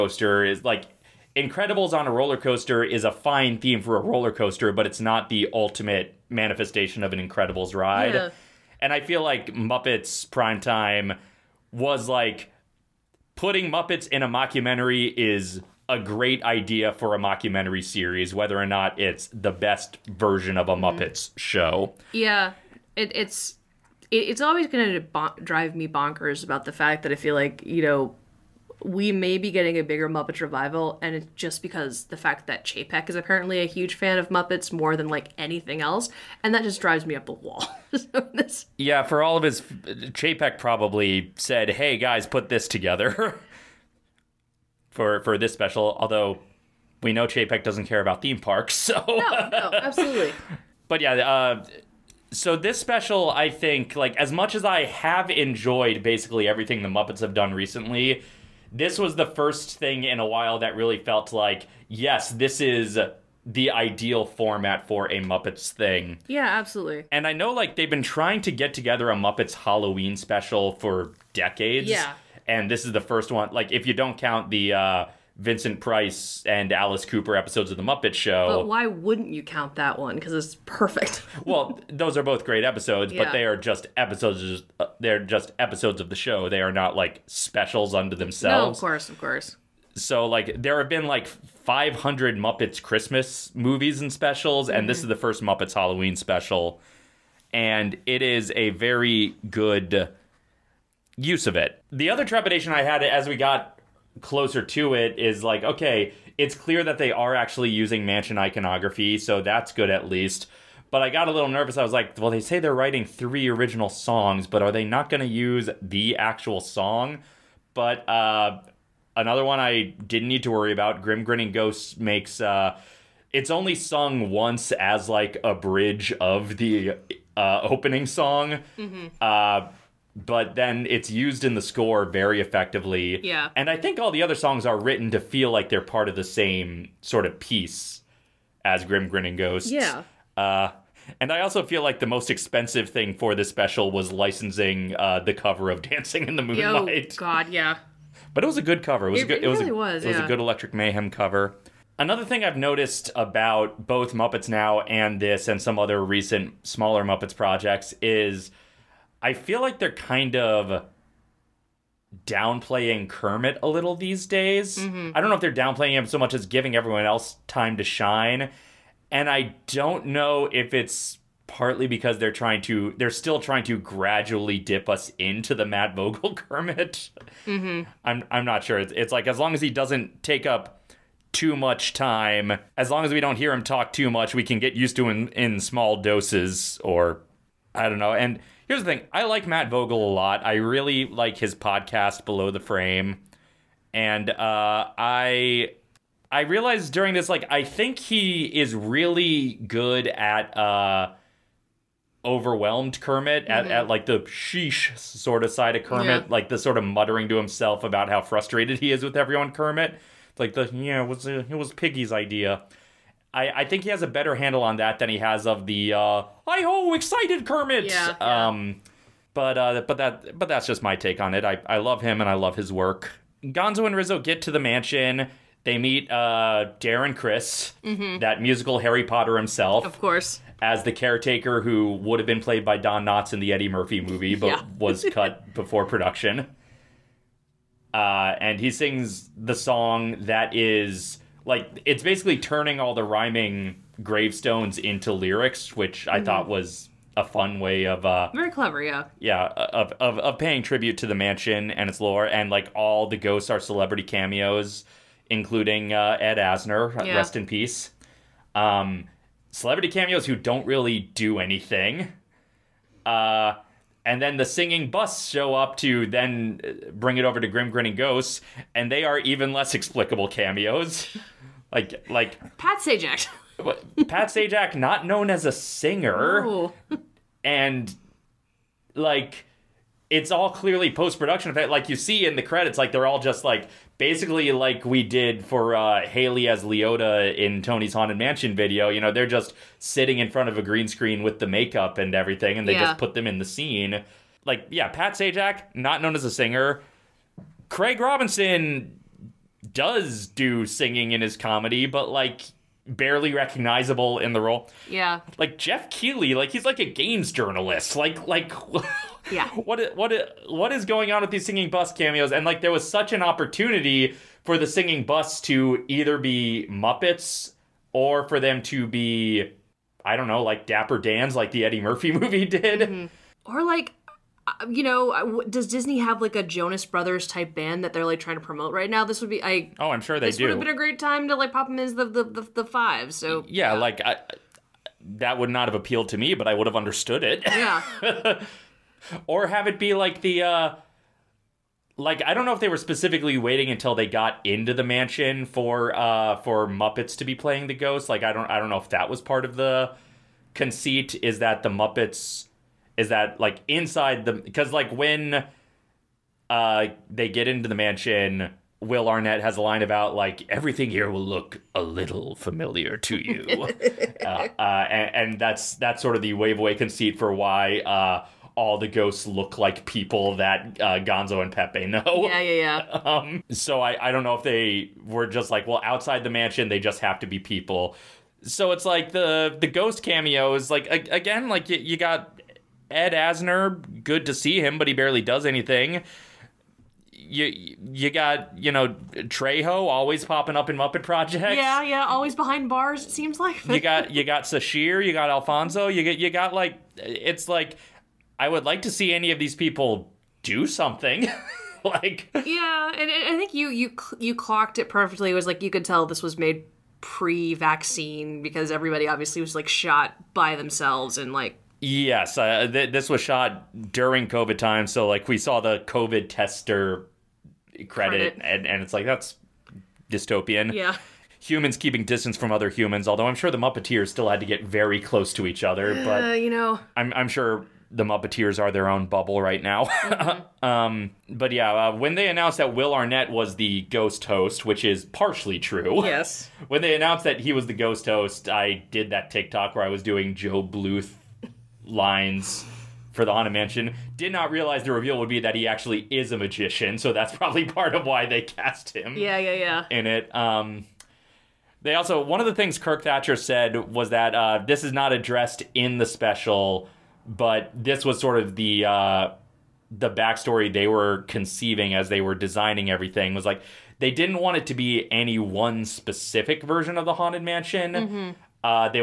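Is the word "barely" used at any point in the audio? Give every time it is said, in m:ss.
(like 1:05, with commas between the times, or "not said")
5:02, 6:24.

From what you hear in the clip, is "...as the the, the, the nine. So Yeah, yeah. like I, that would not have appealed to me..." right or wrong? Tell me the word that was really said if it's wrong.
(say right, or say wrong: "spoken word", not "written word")
wrong: "five", not "nine".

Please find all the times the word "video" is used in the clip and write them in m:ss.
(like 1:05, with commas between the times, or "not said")
4:48.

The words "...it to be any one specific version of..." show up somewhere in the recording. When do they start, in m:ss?
7:44.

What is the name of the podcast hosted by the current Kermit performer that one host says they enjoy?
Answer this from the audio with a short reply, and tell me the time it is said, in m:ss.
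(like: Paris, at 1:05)
Below the Frame, at 3:12.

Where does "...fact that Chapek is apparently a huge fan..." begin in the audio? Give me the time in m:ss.
0:32.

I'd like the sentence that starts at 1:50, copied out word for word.
But I got a little nervous.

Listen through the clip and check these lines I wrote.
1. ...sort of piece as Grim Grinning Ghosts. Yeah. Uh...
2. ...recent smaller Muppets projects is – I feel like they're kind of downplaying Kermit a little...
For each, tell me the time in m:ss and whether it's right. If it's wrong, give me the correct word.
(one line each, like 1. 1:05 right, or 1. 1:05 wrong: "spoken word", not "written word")
1. 2:16 right
2. 2:36 right.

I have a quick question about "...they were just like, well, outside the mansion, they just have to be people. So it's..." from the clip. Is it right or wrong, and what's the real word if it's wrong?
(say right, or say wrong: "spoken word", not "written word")
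right.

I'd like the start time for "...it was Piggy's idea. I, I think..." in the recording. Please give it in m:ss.
3:31.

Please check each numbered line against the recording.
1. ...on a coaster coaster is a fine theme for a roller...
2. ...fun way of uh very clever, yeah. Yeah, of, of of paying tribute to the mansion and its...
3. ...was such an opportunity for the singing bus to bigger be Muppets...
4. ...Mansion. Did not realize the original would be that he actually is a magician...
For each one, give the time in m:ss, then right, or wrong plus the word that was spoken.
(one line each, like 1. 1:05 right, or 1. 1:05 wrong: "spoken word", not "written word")
1. 0:01 wrong: "roller", not "coaster"
2. 4:07 right
3. 5:12 wrong: "either", not "bigger"
4. 7:23 wrong: "reveal", not "original".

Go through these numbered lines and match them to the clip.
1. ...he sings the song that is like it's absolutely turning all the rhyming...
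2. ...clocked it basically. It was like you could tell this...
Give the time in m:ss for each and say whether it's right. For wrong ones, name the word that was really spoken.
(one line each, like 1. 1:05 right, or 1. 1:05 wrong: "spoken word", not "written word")
1. 3:58 wrong: "basically", not "absolutely"
2. 6:44 wrong: "perfectly", not "basically".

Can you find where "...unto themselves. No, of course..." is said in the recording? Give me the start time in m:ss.
1:27.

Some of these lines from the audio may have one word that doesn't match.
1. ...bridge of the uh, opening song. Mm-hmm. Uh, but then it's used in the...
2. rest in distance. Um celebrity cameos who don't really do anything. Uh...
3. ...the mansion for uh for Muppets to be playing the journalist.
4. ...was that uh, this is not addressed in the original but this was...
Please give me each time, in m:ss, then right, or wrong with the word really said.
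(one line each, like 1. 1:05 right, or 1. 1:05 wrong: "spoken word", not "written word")
1. 2:05 right
2. 4:17 wrong: "peace", not "distance"
3. 5:44 wrong: "ghost", not "journalist"
4. 7:33 wrong: "special", not "original".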